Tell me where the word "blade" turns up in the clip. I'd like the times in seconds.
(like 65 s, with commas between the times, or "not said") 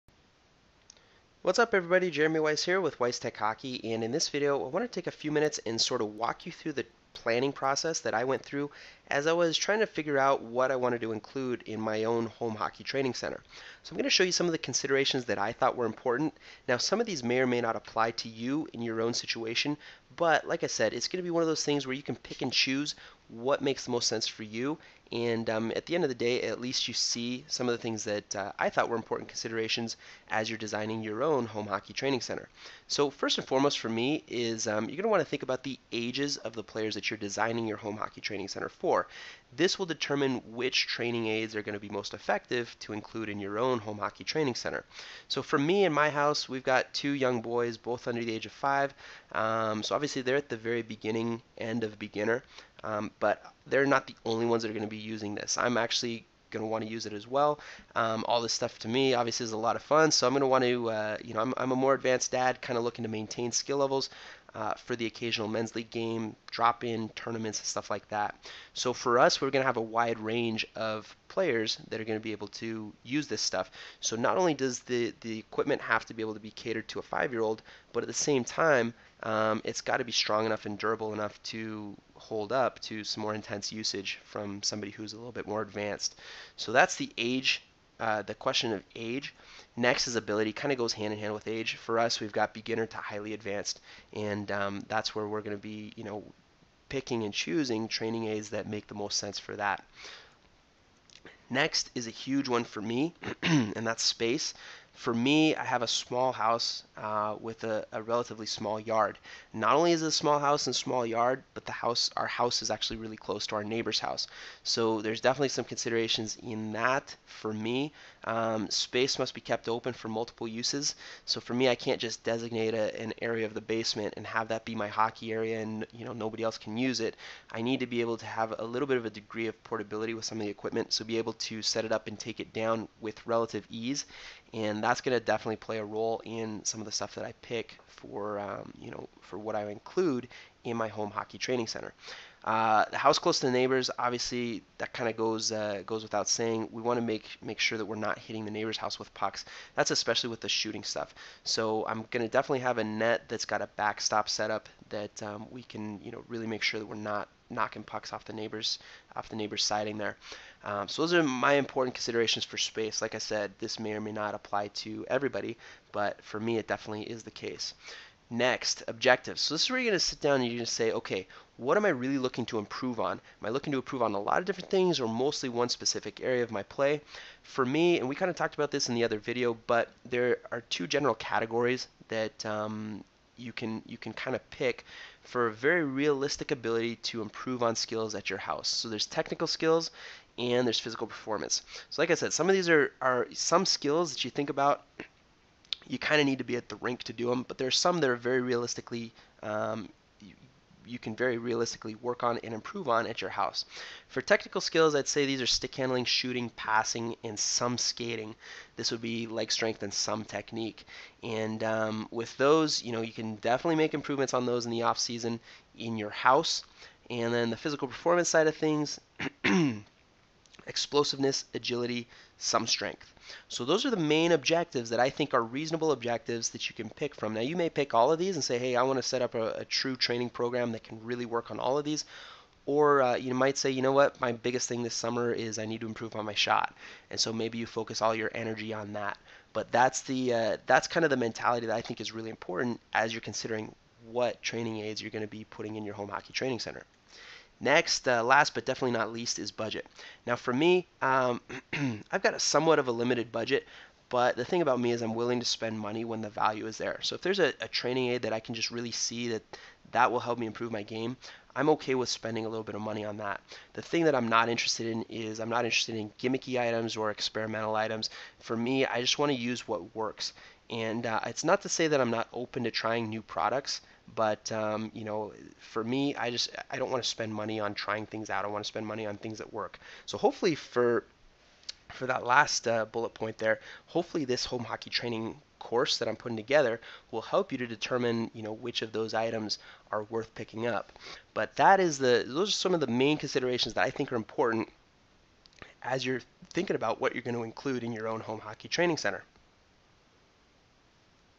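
not said.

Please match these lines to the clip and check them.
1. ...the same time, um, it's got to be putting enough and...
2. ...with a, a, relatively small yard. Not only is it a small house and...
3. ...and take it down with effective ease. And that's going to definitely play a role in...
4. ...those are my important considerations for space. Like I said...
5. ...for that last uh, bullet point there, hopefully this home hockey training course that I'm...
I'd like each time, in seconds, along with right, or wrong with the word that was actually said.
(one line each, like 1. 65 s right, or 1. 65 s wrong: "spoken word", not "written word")
1. 78 s wrong: "strong", not "putting"
2. 107 s right
3. 132 s wrong: "relative", not "effective"
4. 161 s right
5. 281 s right.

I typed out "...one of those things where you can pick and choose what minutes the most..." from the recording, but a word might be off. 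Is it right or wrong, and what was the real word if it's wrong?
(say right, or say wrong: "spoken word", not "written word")
wrong: "makes", not "minutes".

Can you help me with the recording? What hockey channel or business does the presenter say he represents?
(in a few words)
Weiss Tech Hockey.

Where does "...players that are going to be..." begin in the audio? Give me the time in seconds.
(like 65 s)
71 s.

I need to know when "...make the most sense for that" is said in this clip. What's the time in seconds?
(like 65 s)
98 s.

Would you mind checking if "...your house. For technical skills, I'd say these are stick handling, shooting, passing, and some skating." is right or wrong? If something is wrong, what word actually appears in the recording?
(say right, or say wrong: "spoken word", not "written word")
right.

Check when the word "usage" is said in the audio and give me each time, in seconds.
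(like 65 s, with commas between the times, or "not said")
83 s.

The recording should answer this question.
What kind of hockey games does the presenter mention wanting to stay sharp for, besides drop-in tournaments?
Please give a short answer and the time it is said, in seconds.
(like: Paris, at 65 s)
Men's league, at 65 s.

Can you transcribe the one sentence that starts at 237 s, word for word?
And so maybe you focus all your energy on that.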